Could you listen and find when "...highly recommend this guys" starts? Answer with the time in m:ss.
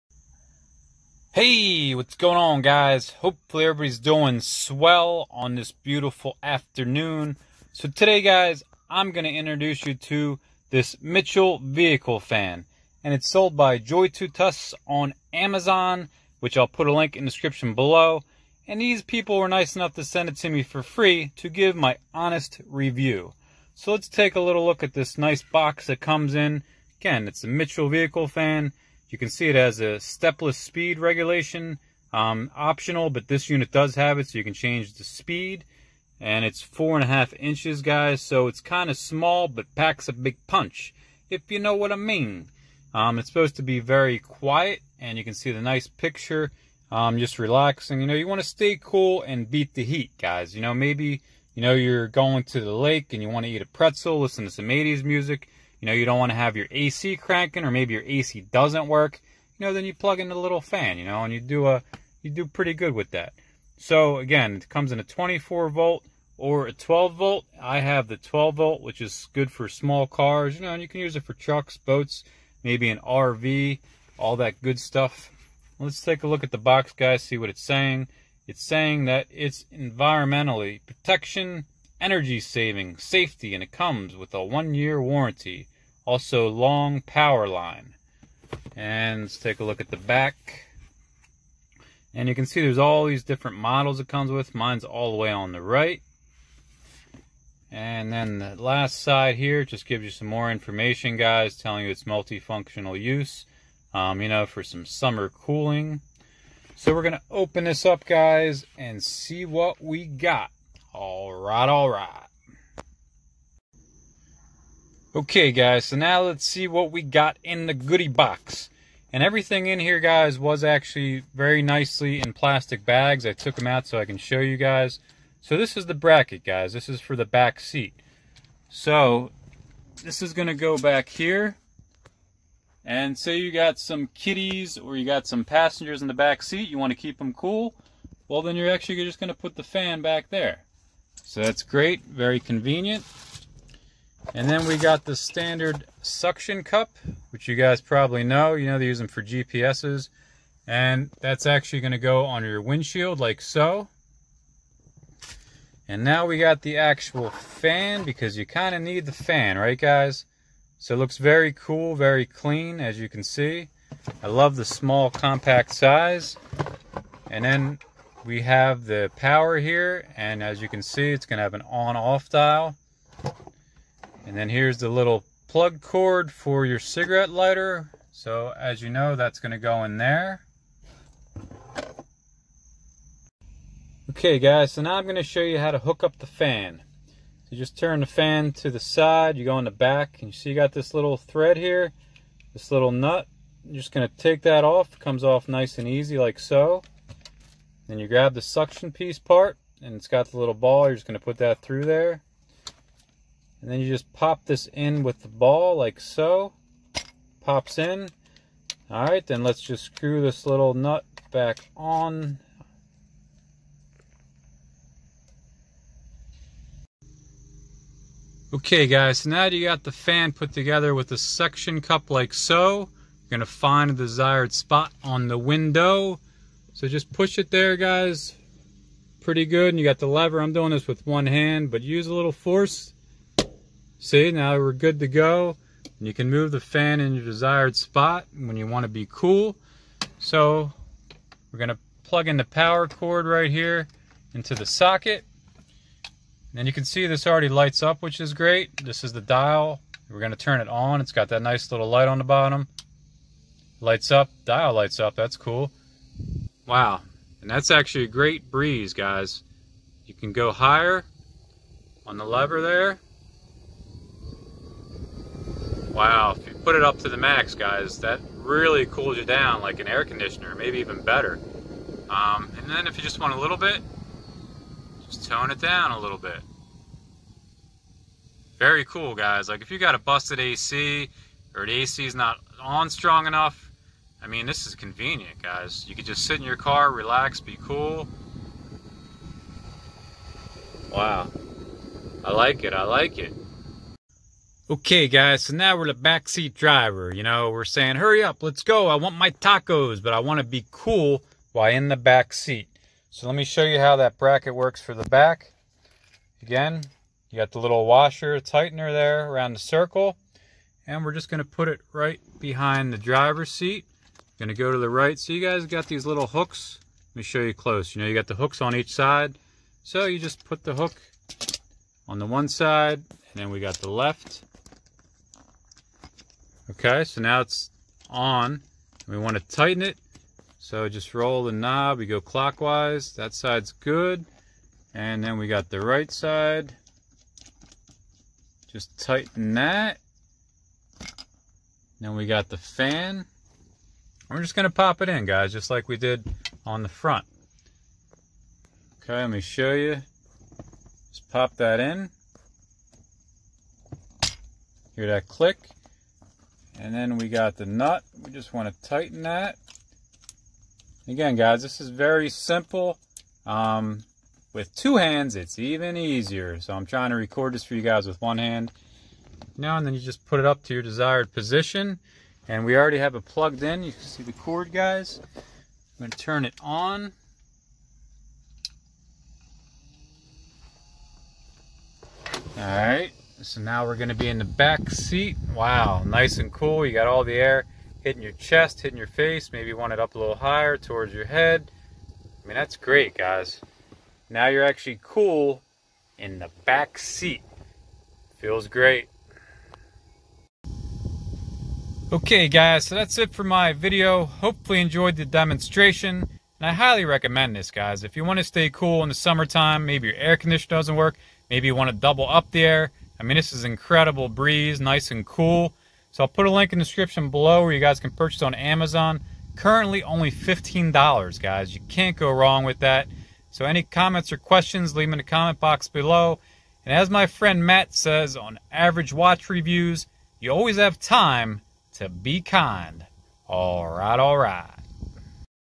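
6:46.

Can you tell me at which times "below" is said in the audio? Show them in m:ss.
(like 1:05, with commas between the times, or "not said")
0:17, 6:57, 7:05.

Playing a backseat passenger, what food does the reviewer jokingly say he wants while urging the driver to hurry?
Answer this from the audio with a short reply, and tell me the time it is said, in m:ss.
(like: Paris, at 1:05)
tacos, at 4:59.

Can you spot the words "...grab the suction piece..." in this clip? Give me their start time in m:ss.
3:18.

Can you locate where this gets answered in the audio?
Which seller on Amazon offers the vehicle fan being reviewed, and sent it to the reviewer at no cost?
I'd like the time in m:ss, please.
0:13.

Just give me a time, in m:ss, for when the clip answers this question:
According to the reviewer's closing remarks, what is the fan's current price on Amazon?
7:00.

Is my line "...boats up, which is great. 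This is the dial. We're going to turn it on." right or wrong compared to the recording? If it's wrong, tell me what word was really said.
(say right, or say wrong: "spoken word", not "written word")
wrong: "lights", not "boats".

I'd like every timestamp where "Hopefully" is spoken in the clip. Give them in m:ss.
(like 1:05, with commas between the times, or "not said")
0:03, 6:44.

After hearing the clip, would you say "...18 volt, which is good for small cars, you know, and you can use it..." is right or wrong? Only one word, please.
wrong.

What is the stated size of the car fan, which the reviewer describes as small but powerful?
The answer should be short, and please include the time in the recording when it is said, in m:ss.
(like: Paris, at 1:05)
4.5 inches, at 0:36.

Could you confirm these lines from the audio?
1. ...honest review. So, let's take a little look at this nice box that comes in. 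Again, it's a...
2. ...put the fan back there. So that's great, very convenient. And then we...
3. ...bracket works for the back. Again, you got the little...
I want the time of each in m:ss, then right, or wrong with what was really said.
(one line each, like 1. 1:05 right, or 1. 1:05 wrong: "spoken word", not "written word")
1. 0:22 right
2. 2:19 right
3. 5:04 right.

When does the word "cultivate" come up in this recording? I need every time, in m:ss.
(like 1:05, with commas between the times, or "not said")
not said.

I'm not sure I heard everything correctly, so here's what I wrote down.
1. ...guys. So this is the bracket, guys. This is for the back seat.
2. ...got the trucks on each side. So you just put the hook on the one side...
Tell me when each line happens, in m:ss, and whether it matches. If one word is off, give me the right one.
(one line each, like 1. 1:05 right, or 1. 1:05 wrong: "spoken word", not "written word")
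1. 2:04 right
2. 5:18 wrong: "hooks", not "trucks".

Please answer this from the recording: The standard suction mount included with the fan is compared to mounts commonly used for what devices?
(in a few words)
GPSs.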